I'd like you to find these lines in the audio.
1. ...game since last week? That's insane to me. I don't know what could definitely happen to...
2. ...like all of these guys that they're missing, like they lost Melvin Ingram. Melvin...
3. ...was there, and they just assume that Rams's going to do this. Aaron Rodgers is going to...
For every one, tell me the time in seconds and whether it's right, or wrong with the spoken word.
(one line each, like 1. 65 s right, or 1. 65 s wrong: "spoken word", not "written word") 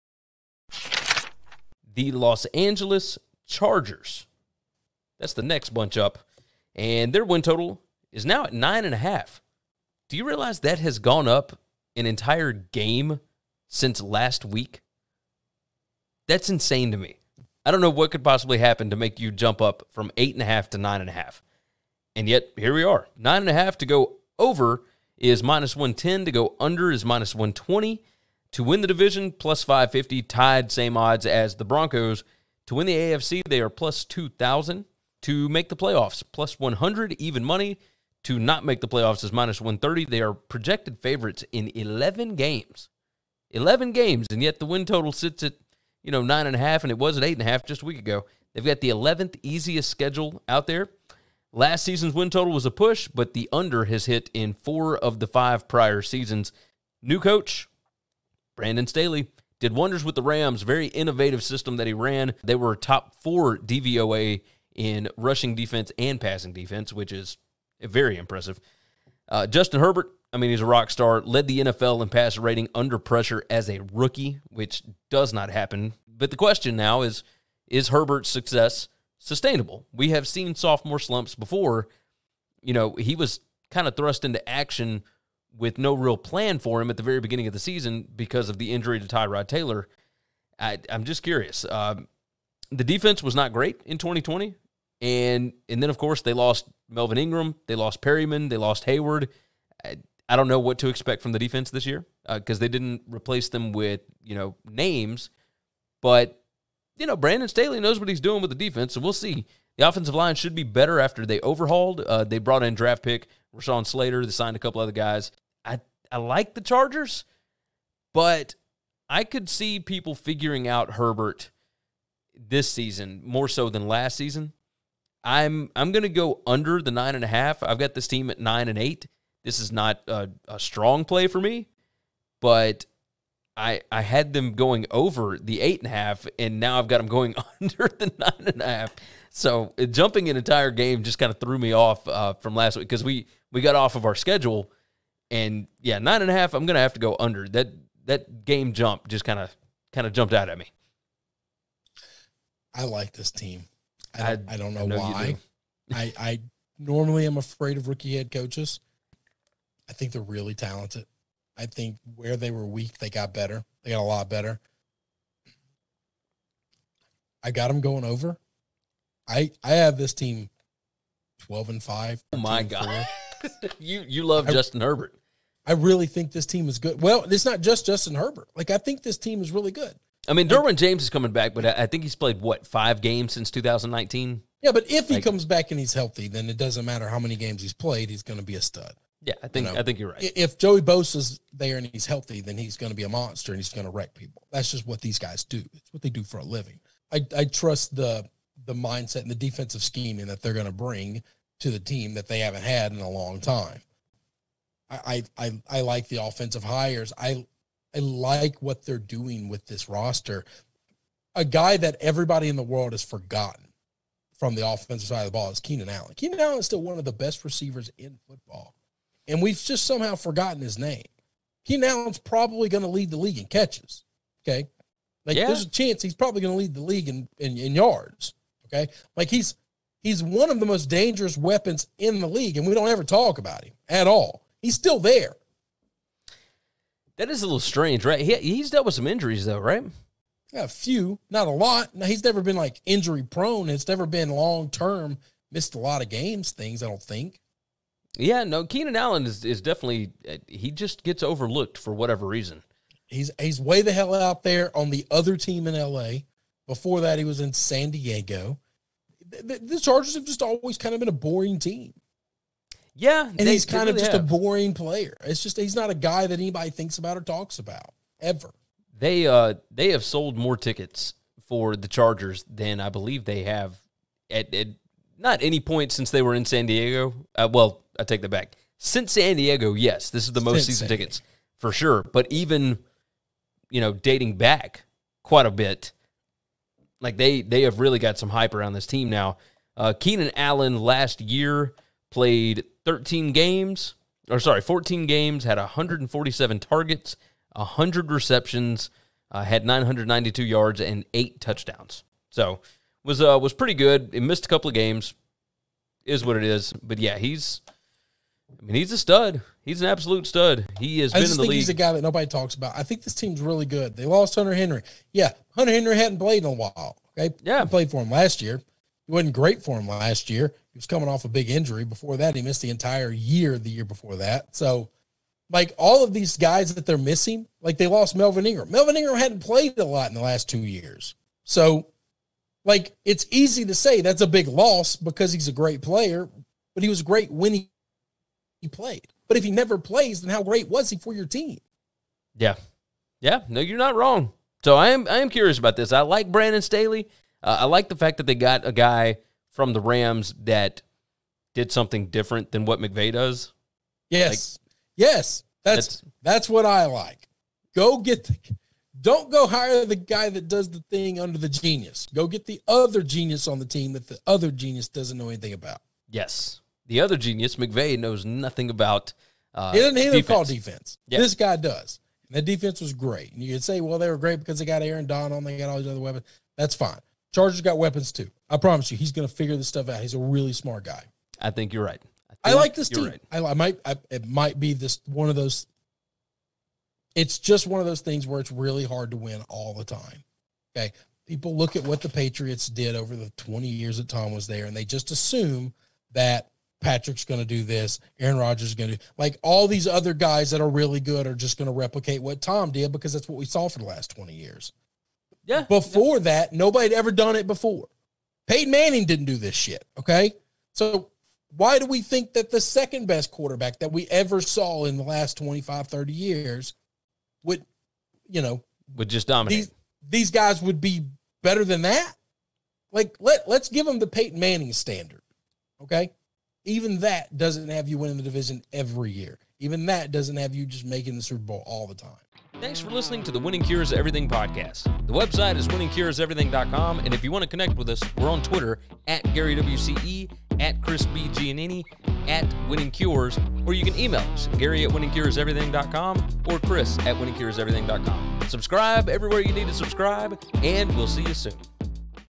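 1. 12 s wrong: "possibly", not "definitely"
2. 325 s right
3. 394 s wrong: "Patrick", not "Rams".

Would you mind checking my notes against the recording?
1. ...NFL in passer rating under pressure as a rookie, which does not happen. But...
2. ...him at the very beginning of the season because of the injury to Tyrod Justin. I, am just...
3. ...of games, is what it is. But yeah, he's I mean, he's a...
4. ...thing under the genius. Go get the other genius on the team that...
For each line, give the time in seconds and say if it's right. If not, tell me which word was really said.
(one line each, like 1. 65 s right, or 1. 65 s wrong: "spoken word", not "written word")
1. 71 s right
2. 86 s wrong: "Taylor", not "Justin"
3. 304 s right
4. 360 s right.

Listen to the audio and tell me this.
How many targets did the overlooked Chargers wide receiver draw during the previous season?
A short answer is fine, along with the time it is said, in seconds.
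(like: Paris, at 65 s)
147, at 295 s.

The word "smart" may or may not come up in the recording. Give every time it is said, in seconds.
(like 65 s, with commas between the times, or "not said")
380 s.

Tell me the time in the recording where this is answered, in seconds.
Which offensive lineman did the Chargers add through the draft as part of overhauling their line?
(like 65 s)
113 s.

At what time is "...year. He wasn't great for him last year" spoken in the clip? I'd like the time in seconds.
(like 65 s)
318 s.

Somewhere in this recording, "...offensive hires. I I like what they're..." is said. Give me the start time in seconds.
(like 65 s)
206 s.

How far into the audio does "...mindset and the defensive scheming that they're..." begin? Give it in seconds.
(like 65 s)
198 s.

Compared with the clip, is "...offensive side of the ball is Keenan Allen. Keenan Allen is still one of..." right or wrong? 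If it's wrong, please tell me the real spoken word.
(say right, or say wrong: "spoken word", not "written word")
right.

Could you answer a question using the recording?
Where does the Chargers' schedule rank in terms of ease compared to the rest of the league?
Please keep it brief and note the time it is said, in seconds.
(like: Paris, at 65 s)
11th easiest, at 48 s.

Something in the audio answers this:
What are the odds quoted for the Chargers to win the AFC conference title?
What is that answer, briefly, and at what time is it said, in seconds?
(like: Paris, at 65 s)
+2000, at 33 s.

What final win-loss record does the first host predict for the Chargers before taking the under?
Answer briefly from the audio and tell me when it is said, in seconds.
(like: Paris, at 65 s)
9 and 8, at 128 s.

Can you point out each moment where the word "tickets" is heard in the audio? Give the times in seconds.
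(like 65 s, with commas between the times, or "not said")
270 s, 280 s.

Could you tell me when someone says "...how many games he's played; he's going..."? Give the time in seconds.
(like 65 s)
187 s.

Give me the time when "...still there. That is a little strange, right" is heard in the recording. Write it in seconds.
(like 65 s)
234 s.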